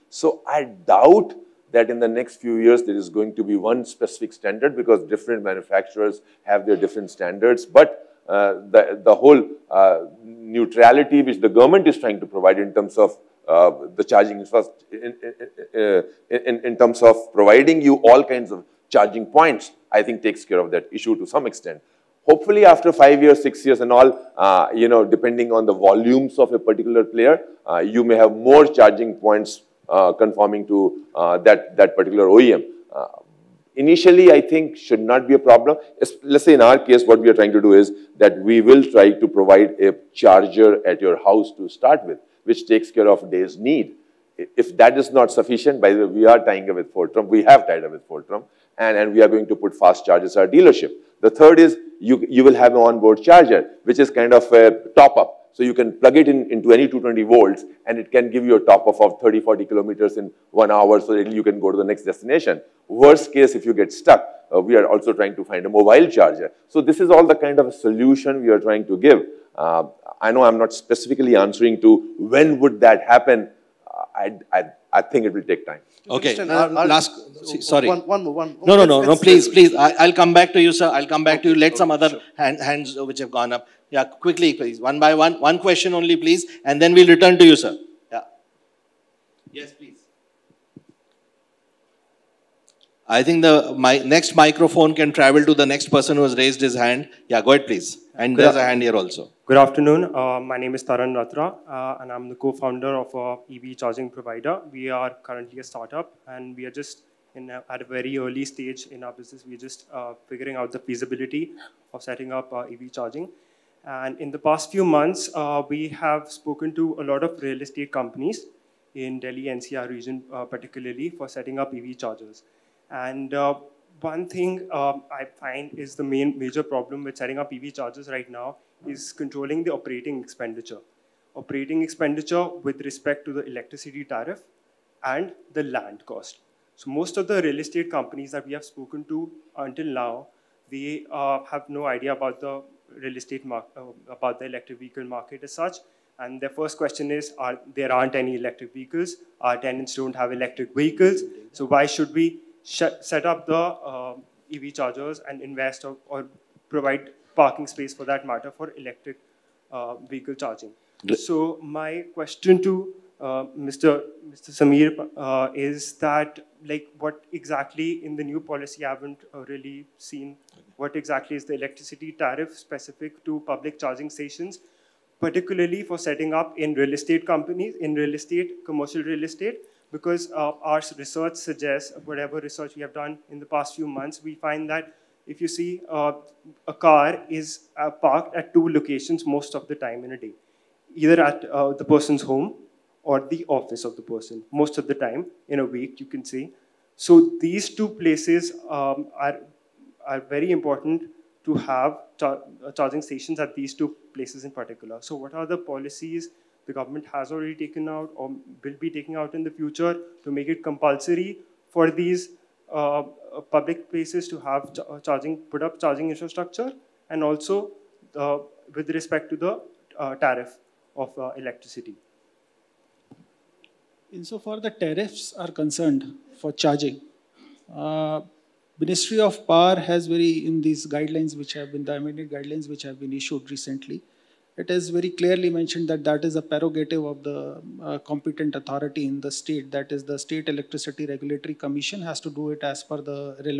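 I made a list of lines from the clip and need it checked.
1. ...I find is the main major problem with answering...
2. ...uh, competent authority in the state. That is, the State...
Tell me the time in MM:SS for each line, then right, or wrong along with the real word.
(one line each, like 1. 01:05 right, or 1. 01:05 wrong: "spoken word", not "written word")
1. 02:05 wrong: "setting", not "answering"
2. 03:57 right.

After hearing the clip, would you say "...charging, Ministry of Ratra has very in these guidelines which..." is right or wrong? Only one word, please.
wrong.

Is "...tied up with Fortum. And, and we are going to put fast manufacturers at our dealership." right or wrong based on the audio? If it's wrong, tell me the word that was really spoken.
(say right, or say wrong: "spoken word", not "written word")
wrong: "chargers", not "manufacturers".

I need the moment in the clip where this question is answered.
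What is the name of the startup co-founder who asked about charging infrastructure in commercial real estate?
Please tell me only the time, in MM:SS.
01:40.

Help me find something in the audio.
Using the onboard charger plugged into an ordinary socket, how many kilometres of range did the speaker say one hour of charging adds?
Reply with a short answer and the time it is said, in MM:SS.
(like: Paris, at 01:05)
30 to 40 kilometers, at 00:59.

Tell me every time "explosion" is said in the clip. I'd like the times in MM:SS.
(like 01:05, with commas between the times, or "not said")
not said.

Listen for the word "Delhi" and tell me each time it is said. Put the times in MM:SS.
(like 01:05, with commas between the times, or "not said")
01:59.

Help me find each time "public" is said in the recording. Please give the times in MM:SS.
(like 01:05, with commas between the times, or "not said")
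02:53, 03:33.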